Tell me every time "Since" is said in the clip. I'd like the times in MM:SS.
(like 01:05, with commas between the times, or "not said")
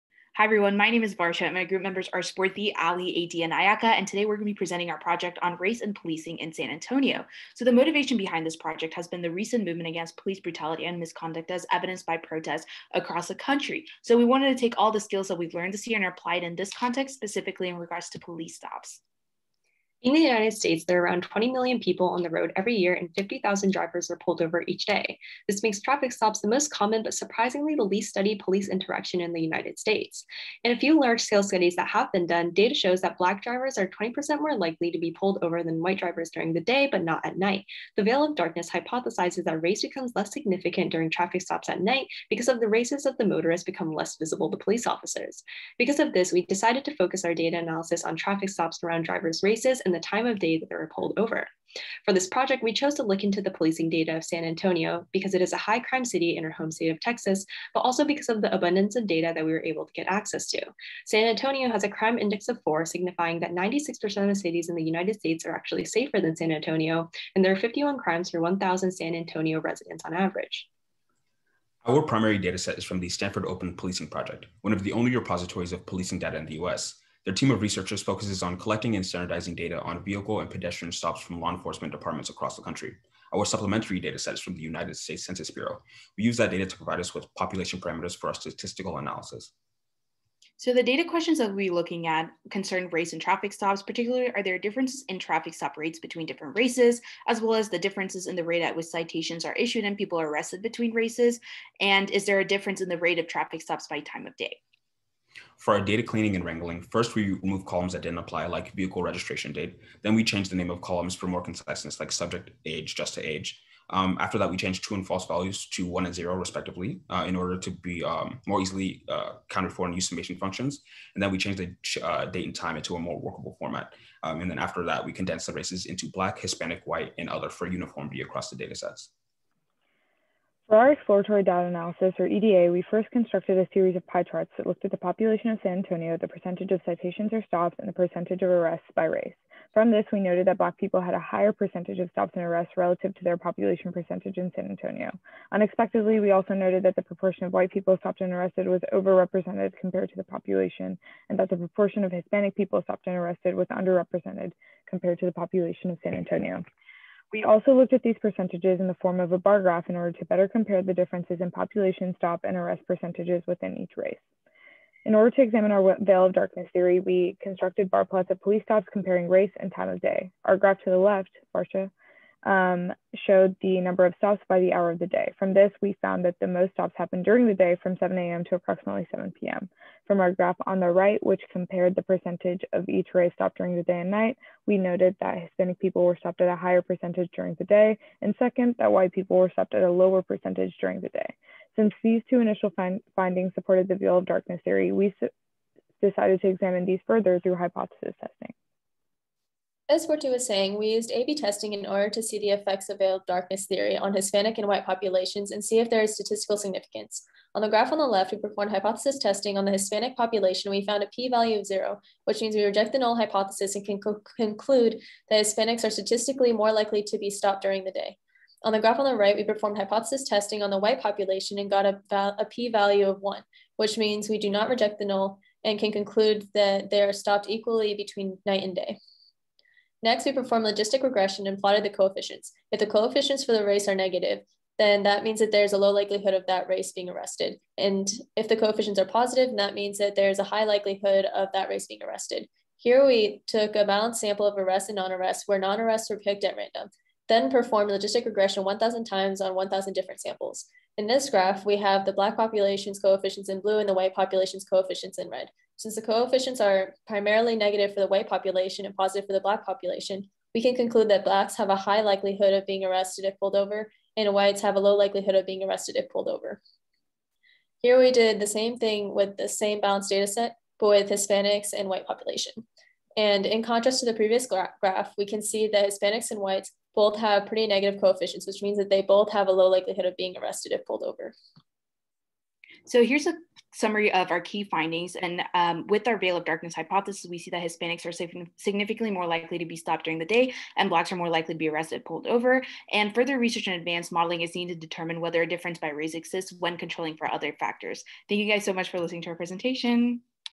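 03:11, 04:15.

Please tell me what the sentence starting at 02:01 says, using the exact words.
And then we change the uh, date and time into a more workable format.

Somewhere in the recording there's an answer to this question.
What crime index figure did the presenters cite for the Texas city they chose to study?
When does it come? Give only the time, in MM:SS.
01:01.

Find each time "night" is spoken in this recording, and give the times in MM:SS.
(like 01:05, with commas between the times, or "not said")
00:37, 00:41, 03:04, 03:48.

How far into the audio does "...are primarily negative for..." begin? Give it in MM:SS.
04:16.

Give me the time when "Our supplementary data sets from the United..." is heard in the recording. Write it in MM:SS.
01:23.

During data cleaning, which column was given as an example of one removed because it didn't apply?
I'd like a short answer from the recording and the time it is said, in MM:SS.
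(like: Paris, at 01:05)
vehicle registration date, at 01:48.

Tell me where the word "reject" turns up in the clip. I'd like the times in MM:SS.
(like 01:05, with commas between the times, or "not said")
03:32, 03:44.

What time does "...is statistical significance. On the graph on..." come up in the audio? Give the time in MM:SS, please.
03:26.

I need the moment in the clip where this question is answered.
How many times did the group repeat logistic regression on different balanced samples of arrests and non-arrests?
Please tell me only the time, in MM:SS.
04:08.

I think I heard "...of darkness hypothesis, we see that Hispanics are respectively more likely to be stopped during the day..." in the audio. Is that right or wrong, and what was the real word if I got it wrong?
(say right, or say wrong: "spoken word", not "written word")
wrong: "significantly", not "respectively".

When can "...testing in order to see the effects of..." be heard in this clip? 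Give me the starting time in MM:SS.
03:21.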